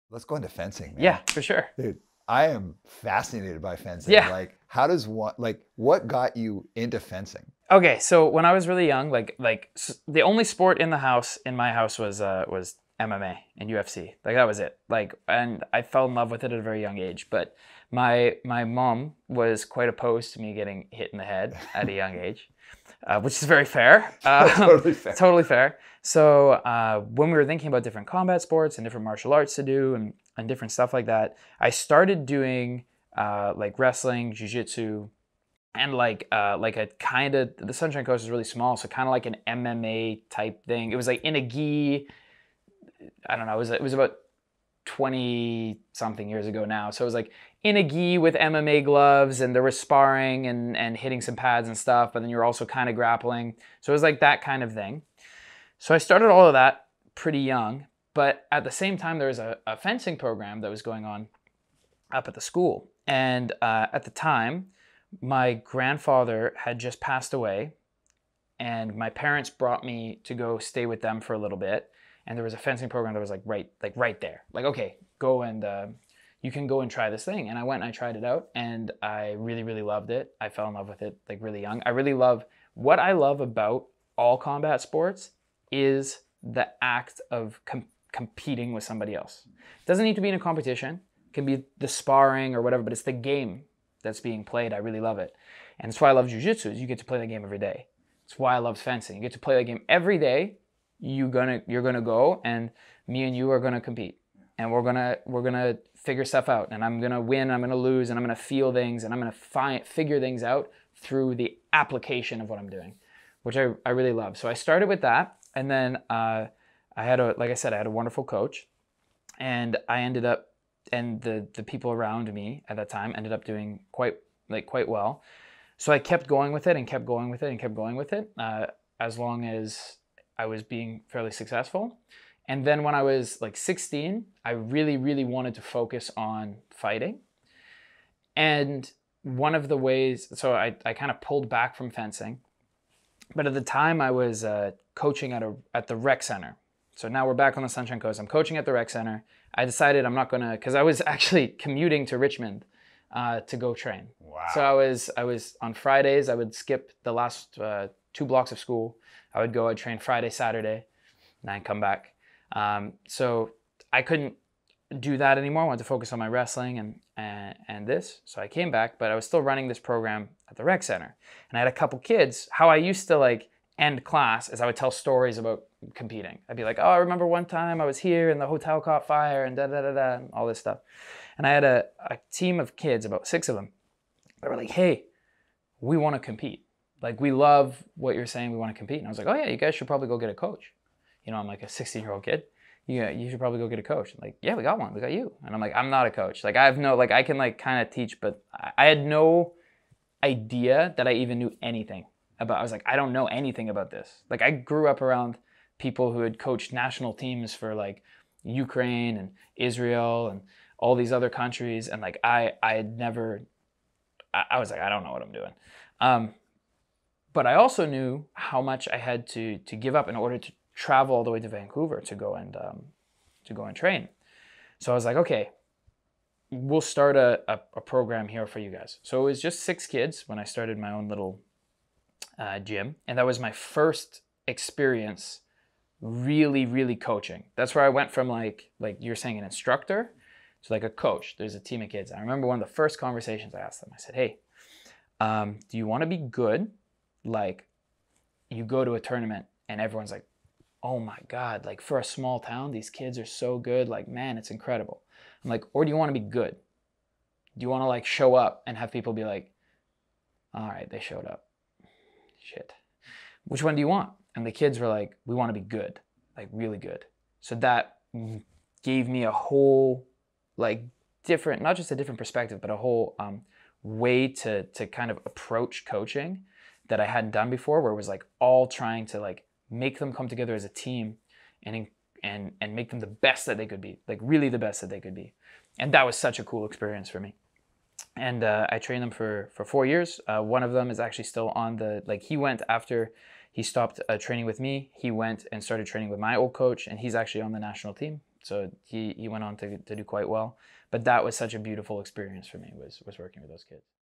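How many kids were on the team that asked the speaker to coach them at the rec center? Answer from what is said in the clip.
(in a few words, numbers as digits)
6.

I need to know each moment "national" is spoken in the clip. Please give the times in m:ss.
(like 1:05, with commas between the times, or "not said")
3:26, 4:57.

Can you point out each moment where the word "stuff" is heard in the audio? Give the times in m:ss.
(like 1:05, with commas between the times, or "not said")
0:30, 0:51, 1:46, 3:00.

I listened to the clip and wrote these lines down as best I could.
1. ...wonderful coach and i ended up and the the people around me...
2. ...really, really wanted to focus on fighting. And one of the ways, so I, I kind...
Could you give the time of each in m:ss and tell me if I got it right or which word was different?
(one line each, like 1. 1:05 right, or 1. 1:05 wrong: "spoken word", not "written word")
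1. 1:57 right
2. 2:14 right.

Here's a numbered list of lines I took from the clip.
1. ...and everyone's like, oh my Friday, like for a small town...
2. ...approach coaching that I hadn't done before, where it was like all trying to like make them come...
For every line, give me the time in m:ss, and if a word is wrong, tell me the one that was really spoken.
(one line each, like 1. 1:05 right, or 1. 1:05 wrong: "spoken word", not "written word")
1. 4:09 wrong: "God", not "Friday"
2. 4:35 right.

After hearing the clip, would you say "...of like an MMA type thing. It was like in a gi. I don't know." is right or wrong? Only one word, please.
right.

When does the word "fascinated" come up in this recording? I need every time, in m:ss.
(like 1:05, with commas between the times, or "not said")
0:02.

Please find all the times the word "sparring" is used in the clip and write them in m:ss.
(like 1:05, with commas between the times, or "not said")
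0:49, 1:31.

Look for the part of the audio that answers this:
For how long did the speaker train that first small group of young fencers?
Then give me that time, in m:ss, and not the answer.
4:49.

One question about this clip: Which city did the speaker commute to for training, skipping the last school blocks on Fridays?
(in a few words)
Richmond.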